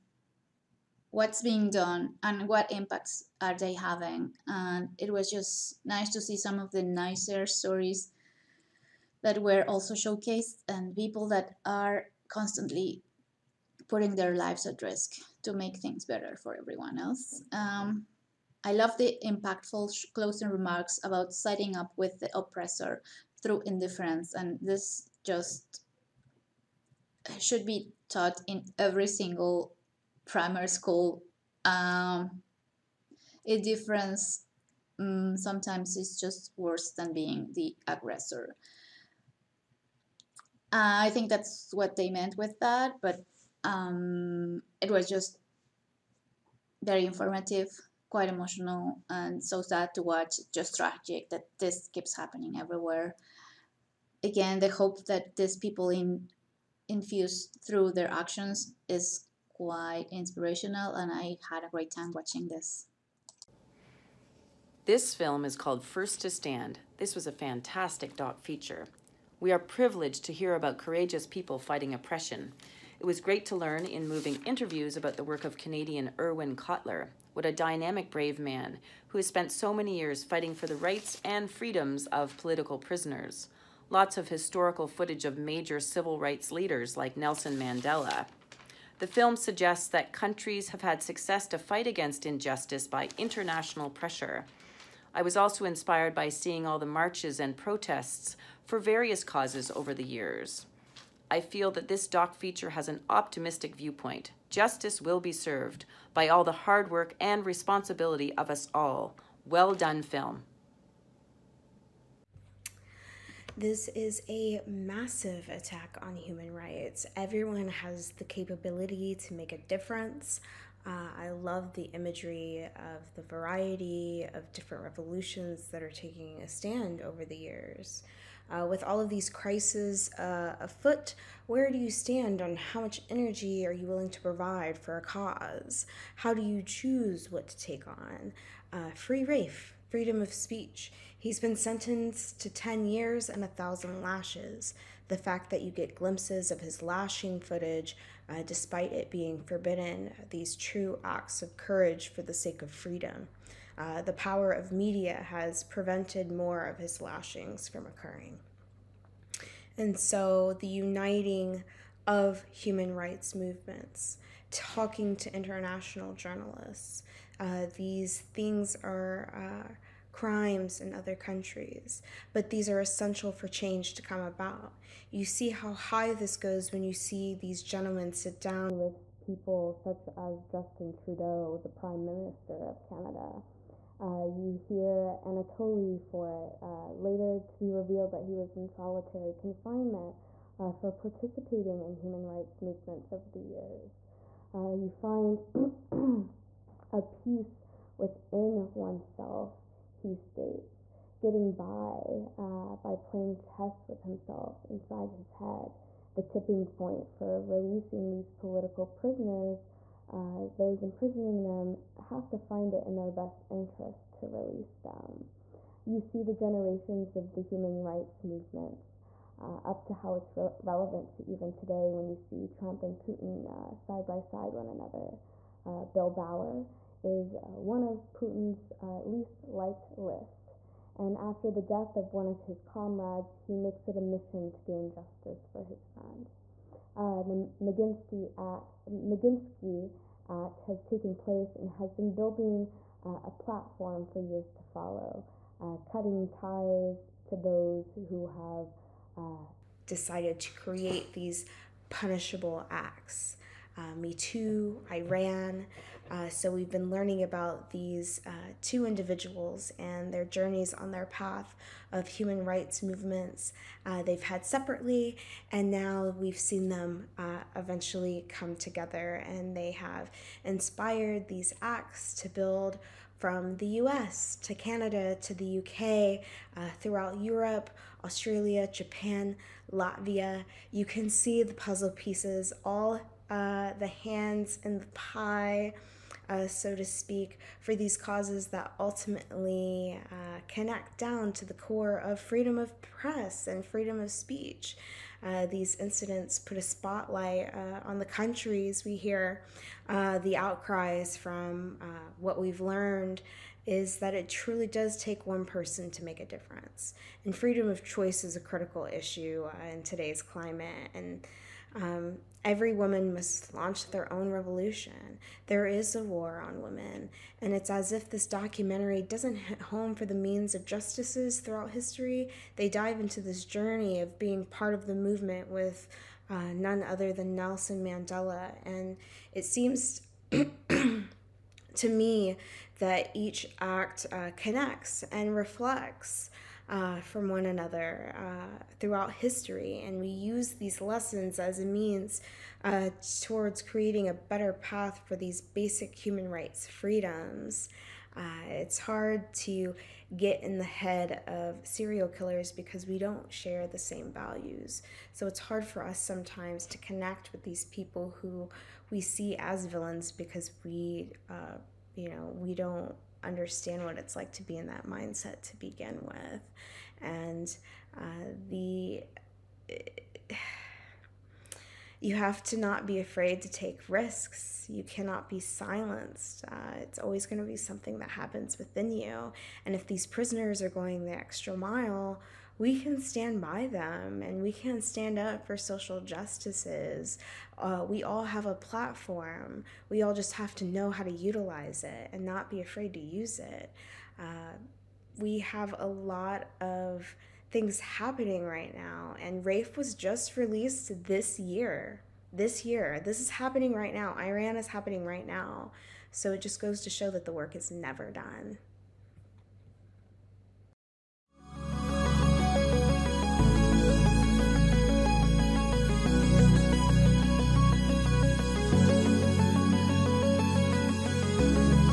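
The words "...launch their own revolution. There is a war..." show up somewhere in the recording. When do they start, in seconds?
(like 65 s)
313 s.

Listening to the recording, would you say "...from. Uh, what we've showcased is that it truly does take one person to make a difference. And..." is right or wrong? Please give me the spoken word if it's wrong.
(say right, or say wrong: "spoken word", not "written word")
wrong: "learned", not "showcased".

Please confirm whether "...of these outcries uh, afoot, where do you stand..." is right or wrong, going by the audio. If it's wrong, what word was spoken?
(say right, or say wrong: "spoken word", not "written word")
wrong: "crises", not "outcries".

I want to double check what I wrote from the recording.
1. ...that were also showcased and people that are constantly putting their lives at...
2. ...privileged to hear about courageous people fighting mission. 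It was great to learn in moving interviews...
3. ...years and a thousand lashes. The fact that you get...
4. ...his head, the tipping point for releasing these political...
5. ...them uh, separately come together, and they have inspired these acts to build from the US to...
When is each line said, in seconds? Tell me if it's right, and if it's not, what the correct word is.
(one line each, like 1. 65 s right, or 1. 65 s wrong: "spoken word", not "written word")
1. 9 s right
2. 69 s wrong: "oppression", not "mission"
3. 142 s right
4. 205 s right
5. 266 s wrong: "eventually", not "separately".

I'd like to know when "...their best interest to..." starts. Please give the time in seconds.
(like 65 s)
212 s.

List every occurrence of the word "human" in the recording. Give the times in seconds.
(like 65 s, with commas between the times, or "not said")
116 s, 162 s, 191 s, 217 s, 262 s, 345 s.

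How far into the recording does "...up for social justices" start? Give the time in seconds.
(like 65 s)
385 s.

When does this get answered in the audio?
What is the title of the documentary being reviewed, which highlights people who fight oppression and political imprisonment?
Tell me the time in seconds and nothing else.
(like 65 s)
65 s.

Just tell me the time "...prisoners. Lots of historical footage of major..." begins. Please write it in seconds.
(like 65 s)
82 s.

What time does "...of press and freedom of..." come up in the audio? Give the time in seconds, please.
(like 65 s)
292 s.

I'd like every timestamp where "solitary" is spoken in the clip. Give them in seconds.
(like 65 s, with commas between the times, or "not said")
188 s.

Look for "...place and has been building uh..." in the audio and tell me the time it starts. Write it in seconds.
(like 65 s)
241 s.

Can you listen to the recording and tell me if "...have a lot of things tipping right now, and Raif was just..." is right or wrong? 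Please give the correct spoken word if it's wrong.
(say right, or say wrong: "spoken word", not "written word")
wrong: "happening", not "tipping".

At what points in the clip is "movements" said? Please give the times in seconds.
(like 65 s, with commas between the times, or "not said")
163 s, 192 s, 218 s, 262 s, 324 s.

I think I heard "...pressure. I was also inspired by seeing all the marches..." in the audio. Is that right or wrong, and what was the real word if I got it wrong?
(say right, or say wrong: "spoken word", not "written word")
right.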